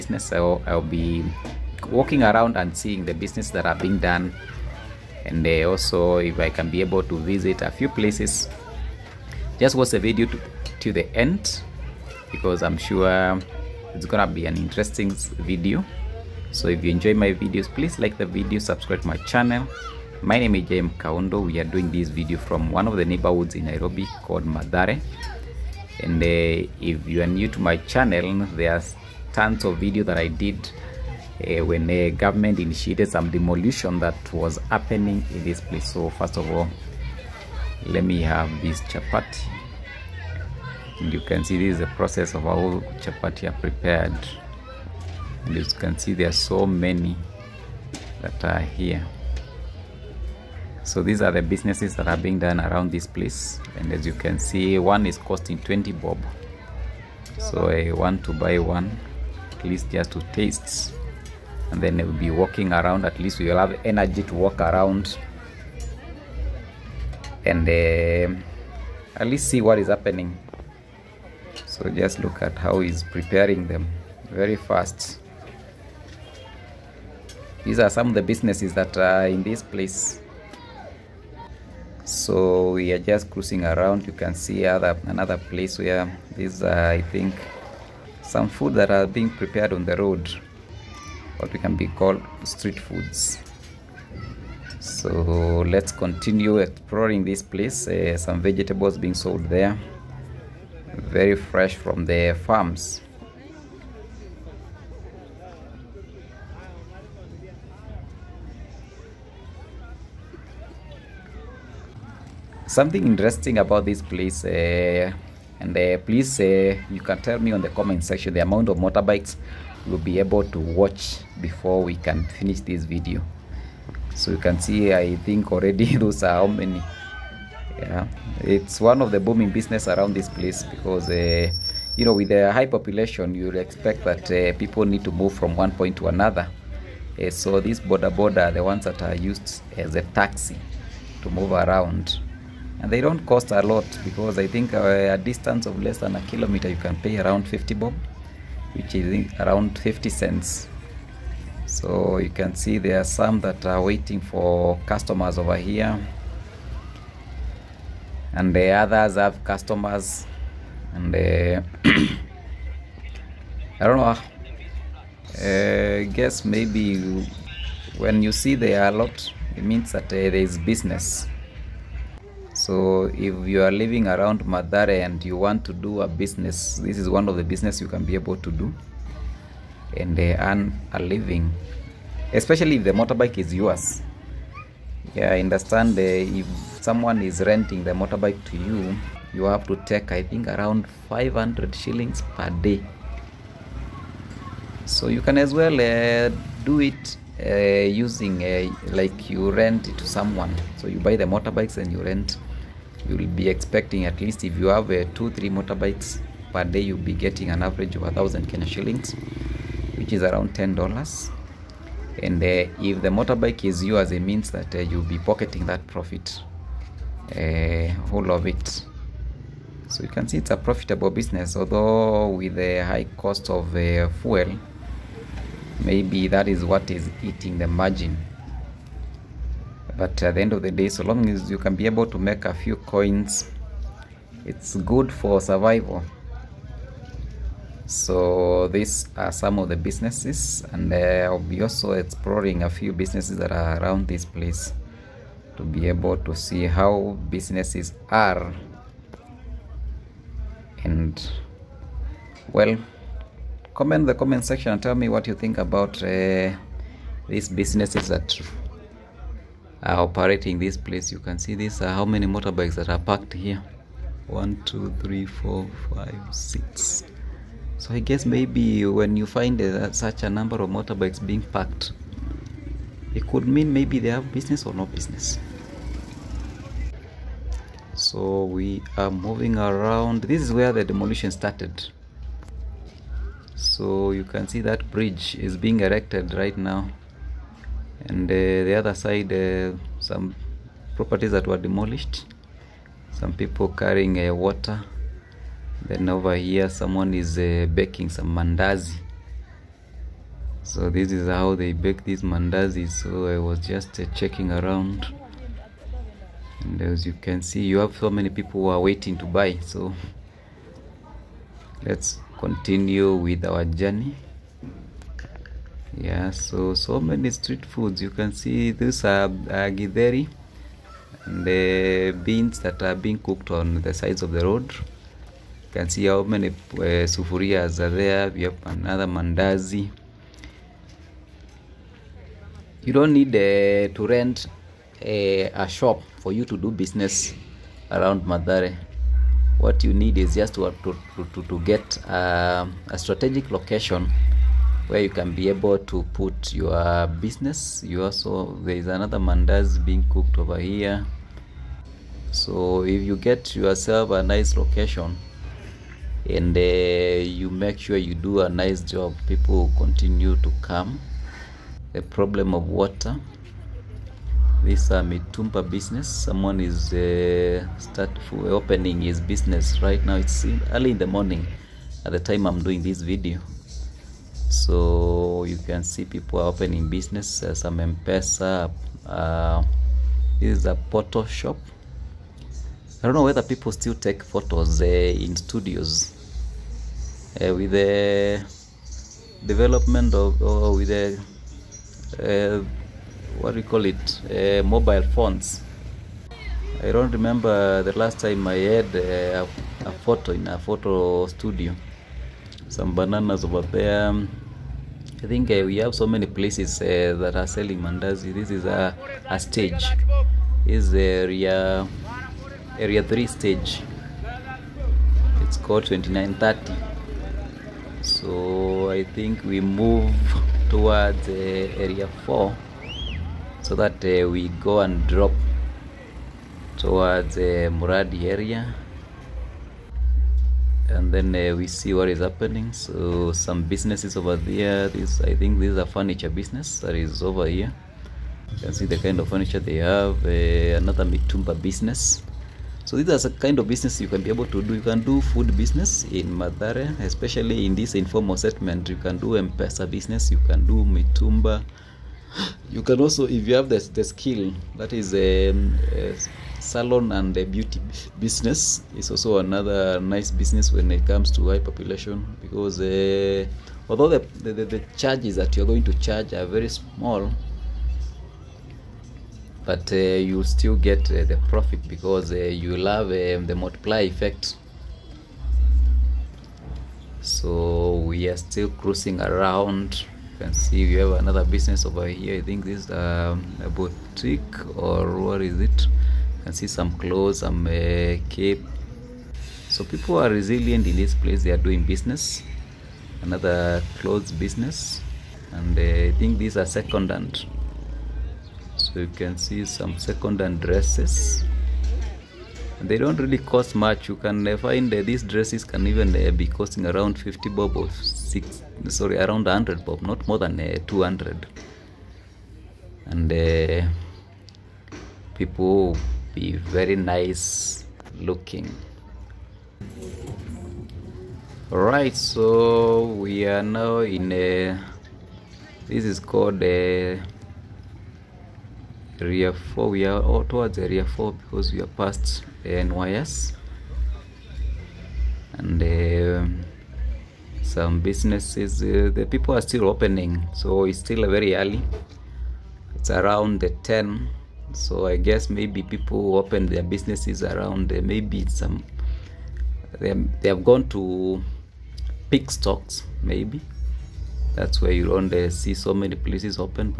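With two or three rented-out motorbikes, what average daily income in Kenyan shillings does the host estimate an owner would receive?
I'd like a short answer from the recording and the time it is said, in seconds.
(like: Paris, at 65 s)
1,000 Kenya shillings, at 208 s.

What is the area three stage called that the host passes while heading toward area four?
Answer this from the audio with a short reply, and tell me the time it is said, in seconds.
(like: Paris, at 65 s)
2930, at 415 s.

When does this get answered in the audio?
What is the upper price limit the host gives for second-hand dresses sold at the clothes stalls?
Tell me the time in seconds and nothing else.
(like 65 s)
510 s.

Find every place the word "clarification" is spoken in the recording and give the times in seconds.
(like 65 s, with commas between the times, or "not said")
not said.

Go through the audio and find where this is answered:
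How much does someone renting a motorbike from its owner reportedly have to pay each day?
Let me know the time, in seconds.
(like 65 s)
191 s.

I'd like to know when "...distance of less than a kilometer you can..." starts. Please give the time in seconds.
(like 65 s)
145 s.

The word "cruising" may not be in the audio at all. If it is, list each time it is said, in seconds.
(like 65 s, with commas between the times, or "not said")
83 s, 478 s.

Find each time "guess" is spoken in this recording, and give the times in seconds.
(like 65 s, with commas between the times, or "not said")
166 s, 267 s, 545 s.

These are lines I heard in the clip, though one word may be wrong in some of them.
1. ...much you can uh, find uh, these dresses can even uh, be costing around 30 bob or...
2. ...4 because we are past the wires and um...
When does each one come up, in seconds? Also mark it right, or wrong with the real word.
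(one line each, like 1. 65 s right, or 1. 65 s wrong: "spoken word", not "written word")
1. 503 s wrong: "50", not "30"
2. 531 s right.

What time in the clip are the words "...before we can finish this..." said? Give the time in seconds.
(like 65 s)
121 s.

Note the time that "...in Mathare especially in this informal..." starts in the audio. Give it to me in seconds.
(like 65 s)
446 s.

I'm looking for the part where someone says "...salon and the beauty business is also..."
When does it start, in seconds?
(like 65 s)
456 s.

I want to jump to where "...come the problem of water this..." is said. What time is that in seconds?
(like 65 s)
360 s.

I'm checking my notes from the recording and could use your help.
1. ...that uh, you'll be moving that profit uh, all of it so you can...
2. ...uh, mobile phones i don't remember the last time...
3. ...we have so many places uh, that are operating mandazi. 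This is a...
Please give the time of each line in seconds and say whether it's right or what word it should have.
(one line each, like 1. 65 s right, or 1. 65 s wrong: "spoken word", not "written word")
1. 214 s wrong: "pocketing", not "moving"
2. 394 s right
3. 405 s wrong: "selling", not "operating".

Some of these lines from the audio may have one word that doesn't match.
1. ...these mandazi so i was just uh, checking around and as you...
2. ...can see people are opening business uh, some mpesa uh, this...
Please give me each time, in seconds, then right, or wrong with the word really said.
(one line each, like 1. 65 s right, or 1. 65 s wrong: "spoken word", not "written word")
1. 302 s right
2. 375 s right.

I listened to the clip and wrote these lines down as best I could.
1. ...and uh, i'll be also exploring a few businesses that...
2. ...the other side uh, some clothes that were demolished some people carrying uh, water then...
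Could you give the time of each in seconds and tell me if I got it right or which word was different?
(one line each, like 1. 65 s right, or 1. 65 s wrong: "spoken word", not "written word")
1. 240 s right
2. 288 s wrong: "properties", not "clothes".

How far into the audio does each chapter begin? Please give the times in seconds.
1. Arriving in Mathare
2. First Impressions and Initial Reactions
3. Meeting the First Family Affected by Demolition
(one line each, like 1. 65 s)
1. 96 s
2. 231 s
3. 366 s.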